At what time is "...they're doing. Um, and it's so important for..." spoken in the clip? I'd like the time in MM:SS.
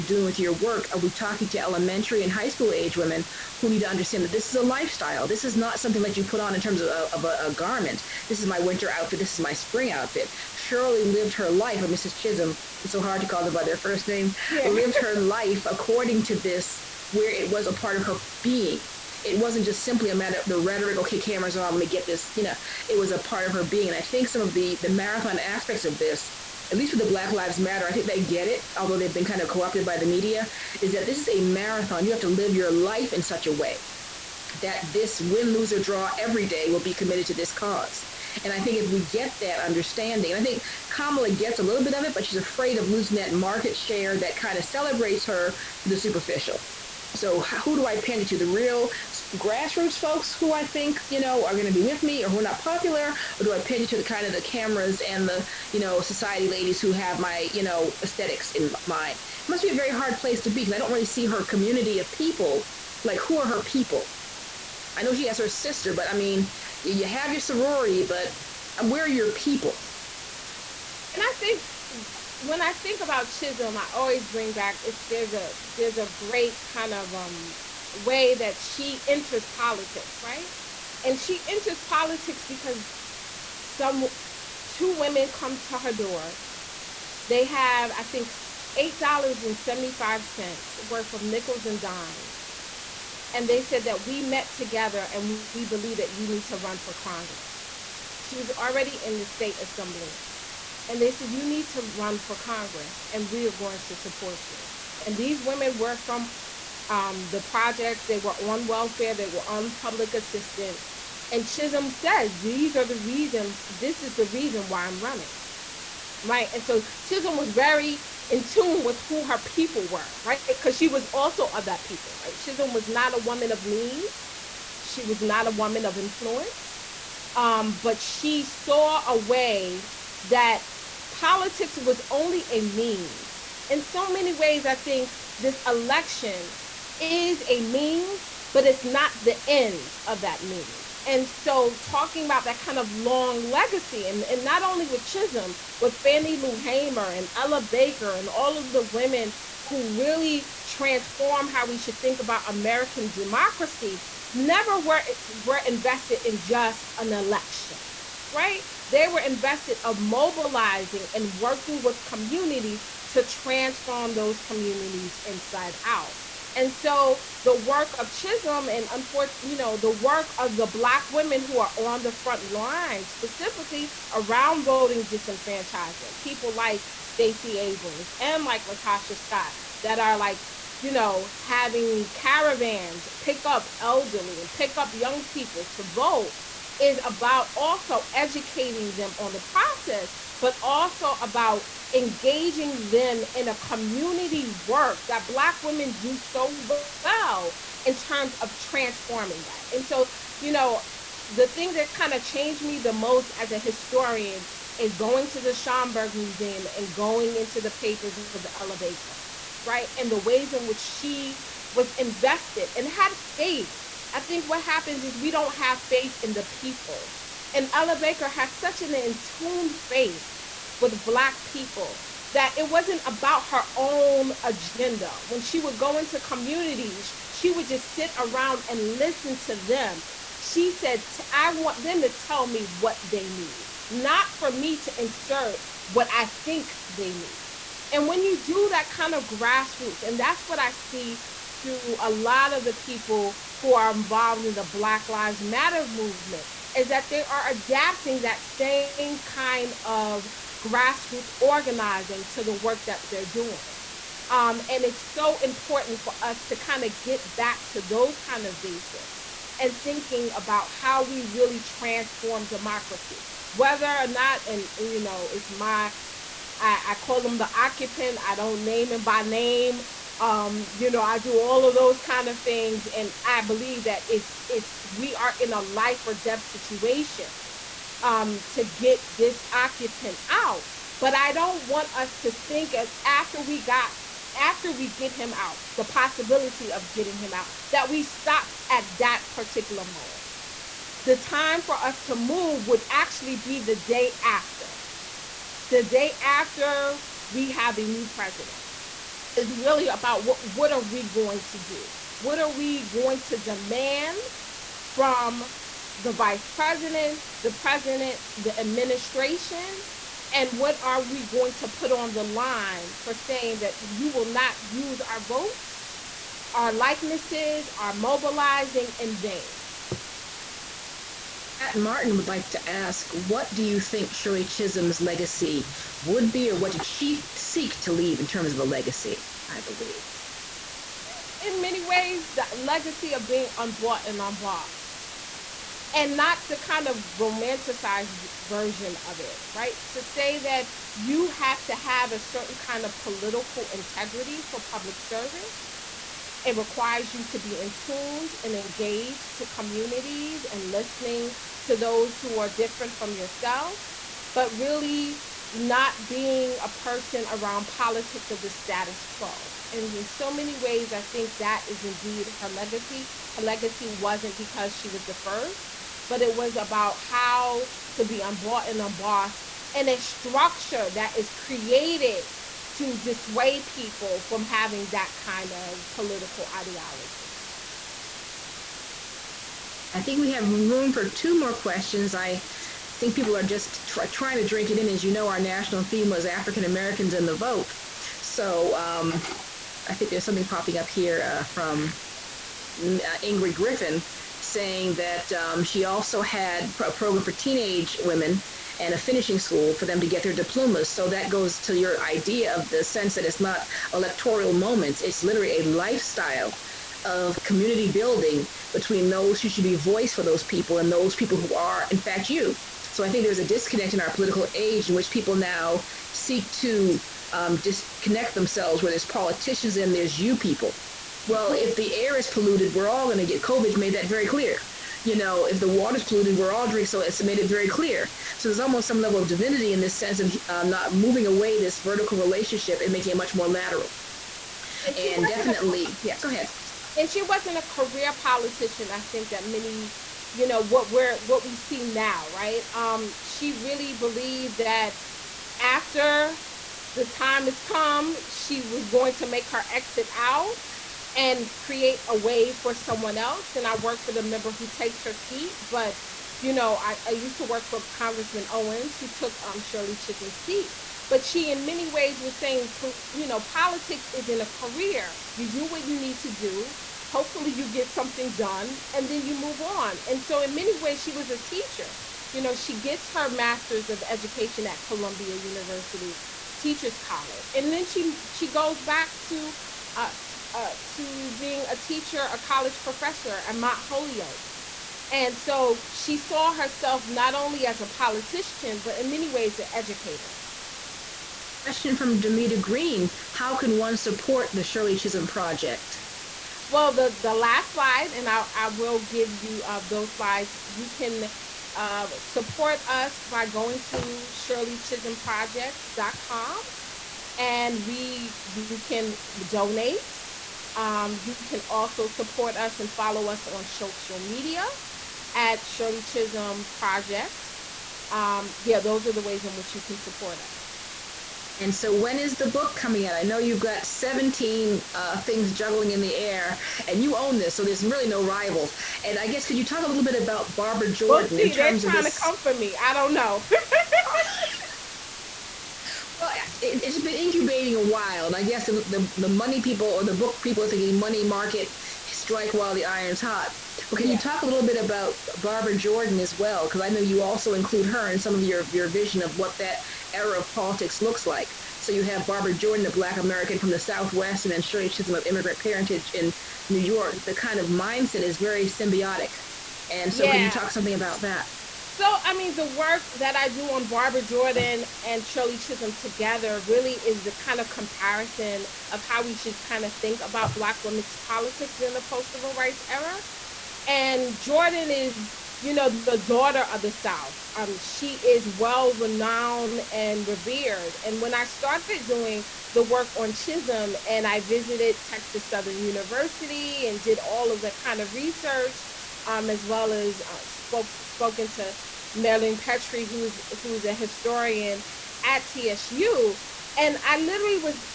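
04:13.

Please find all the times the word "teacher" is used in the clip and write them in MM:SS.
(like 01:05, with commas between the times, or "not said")
07:51, 07:56, 08:01.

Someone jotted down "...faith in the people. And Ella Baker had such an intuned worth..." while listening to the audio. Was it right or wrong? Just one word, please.
wrong.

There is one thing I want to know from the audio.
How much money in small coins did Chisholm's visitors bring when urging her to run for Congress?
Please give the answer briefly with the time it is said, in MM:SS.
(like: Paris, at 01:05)
$8.75, at 01:28.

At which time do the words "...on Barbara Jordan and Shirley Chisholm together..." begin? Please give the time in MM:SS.
09:23.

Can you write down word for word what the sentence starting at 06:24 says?
As you know, our national theme was African Americans and the vote.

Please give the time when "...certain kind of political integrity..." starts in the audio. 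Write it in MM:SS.
05:42.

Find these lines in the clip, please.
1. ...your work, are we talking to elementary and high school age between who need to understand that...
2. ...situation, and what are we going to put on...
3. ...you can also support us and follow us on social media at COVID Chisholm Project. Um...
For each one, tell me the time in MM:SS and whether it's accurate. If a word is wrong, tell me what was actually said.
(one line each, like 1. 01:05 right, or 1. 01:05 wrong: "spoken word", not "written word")
1. 00:00 wrong: "women", not "between"
2. 05:08 wrong: "administration", not "situation"
3. 08:31 wrong: "Shirley", not "COVID".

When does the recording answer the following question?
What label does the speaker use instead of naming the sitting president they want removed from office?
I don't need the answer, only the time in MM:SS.
04:27.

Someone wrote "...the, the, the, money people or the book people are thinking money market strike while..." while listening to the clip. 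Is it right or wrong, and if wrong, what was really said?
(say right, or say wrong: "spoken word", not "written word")
right.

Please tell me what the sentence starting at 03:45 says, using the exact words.
When she would go into communities, she would just sit around and listen to them.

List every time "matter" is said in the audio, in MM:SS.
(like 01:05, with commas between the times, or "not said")
00:20, 00:27, 04:05.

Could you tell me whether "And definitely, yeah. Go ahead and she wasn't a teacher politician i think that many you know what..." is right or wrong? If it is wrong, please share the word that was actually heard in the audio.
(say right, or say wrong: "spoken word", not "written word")
wrong: "career", not "teacher".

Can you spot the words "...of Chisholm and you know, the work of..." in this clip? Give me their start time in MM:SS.
02:47.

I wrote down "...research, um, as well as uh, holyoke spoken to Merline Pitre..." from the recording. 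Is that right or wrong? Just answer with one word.
wrong.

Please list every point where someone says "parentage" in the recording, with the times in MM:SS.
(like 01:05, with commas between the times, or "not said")
09:15.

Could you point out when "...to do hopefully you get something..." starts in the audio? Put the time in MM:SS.
07:46.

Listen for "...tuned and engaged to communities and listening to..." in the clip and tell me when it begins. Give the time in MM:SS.
05:47.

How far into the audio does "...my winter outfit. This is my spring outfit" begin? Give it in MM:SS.
00:08.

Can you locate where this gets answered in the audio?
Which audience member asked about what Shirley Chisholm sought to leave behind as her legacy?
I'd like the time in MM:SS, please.
05:21.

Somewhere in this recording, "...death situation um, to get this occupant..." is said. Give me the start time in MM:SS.
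04:36.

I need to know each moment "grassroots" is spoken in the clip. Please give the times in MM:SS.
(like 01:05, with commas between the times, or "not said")
00:49, 03:59, 04:10.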